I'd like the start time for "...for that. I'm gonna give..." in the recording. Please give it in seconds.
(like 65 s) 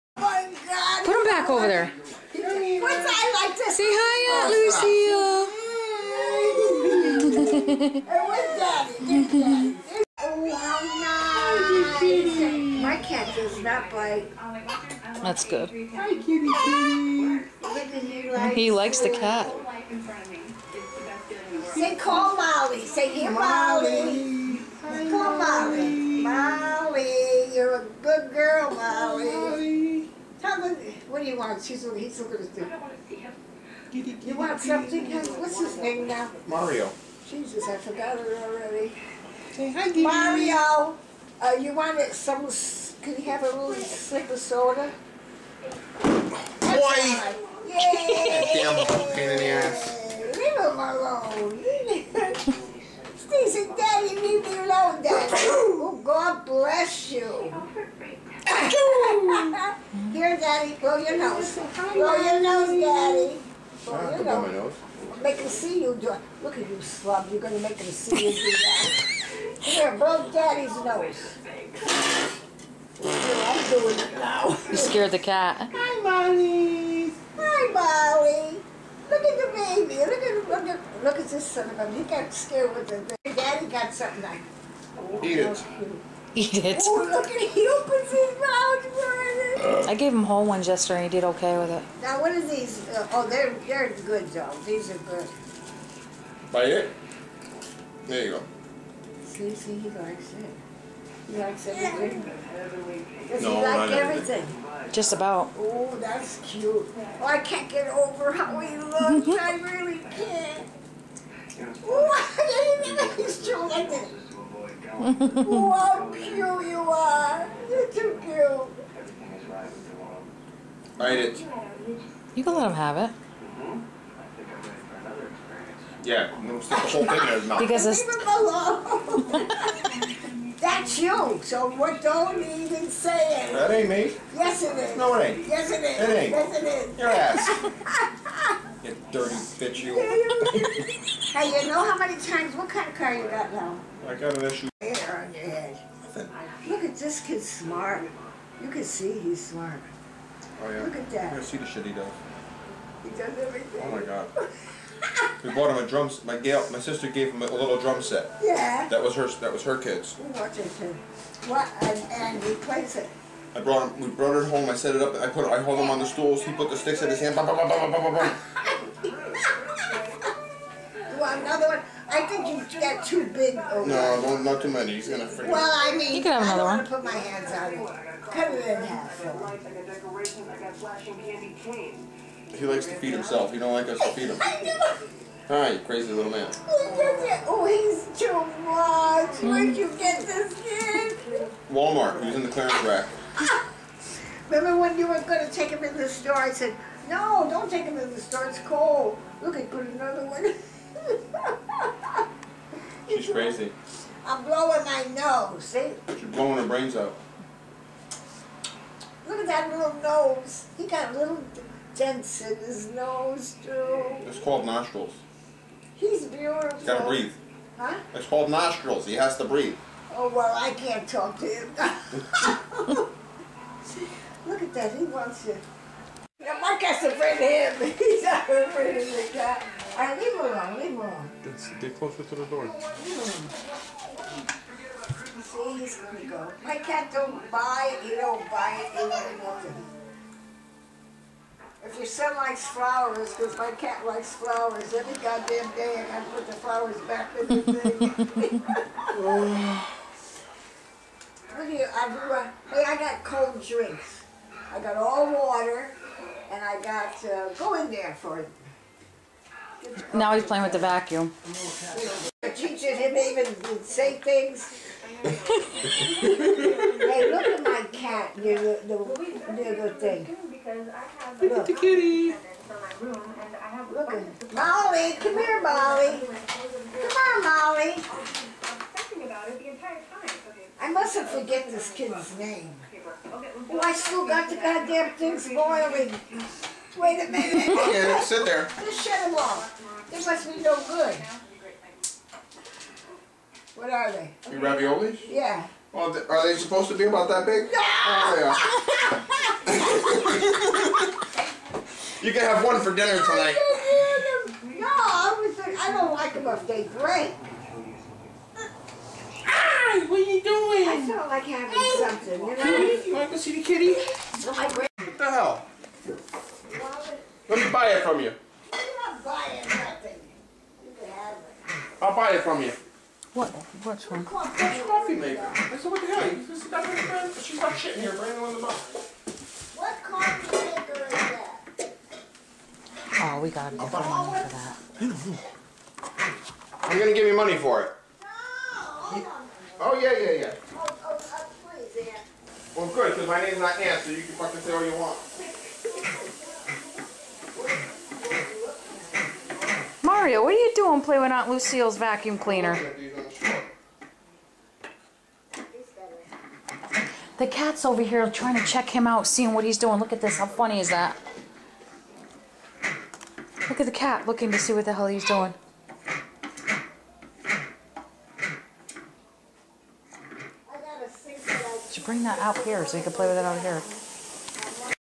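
334 s.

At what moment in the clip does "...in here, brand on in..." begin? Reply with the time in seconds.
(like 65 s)
327 s.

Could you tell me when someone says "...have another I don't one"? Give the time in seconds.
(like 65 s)
176 s.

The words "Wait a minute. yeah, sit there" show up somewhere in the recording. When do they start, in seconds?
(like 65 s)
286 s.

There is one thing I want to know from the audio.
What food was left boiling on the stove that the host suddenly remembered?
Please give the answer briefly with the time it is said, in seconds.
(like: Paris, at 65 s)
raviolis, at 294 s.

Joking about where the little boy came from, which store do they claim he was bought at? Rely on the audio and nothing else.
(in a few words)
Walmart.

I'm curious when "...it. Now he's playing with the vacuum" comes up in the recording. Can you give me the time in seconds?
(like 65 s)
258 s.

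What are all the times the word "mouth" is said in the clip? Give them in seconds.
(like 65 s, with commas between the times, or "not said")
88 s, 127 s.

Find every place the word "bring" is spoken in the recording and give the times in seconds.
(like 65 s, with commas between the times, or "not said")
227 s, 372 s.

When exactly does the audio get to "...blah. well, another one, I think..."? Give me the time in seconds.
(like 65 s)
168 s.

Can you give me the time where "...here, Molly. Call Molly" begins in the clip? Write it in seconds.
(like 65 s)
23 s.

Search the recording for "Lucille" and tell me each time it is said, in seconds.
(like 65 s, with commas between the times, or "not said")
7 s, 351 s.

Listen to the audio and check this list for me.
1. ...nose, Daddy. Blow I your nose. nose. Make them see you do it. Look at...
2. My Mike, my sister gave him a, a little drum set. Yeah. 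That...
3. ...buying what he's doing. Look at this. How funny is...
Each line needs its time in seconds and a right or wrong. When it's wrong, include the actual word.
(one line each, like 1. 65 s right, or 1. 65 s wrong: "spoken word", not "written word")
1. 62 s right
2. 156 s wrong: "Gail", not "Mike"
3. 359 s wrong: "seeing", not "buying".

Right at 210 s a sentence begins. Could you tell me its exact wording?
He got little dents in his nose, too.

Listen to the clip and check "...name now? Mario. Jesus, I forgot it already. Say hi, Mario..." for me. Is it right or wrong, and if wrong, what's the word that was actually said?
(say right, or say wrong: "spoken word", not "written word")
right.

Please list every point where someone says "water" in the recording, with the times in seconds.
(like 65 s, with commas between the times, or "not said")
255 s.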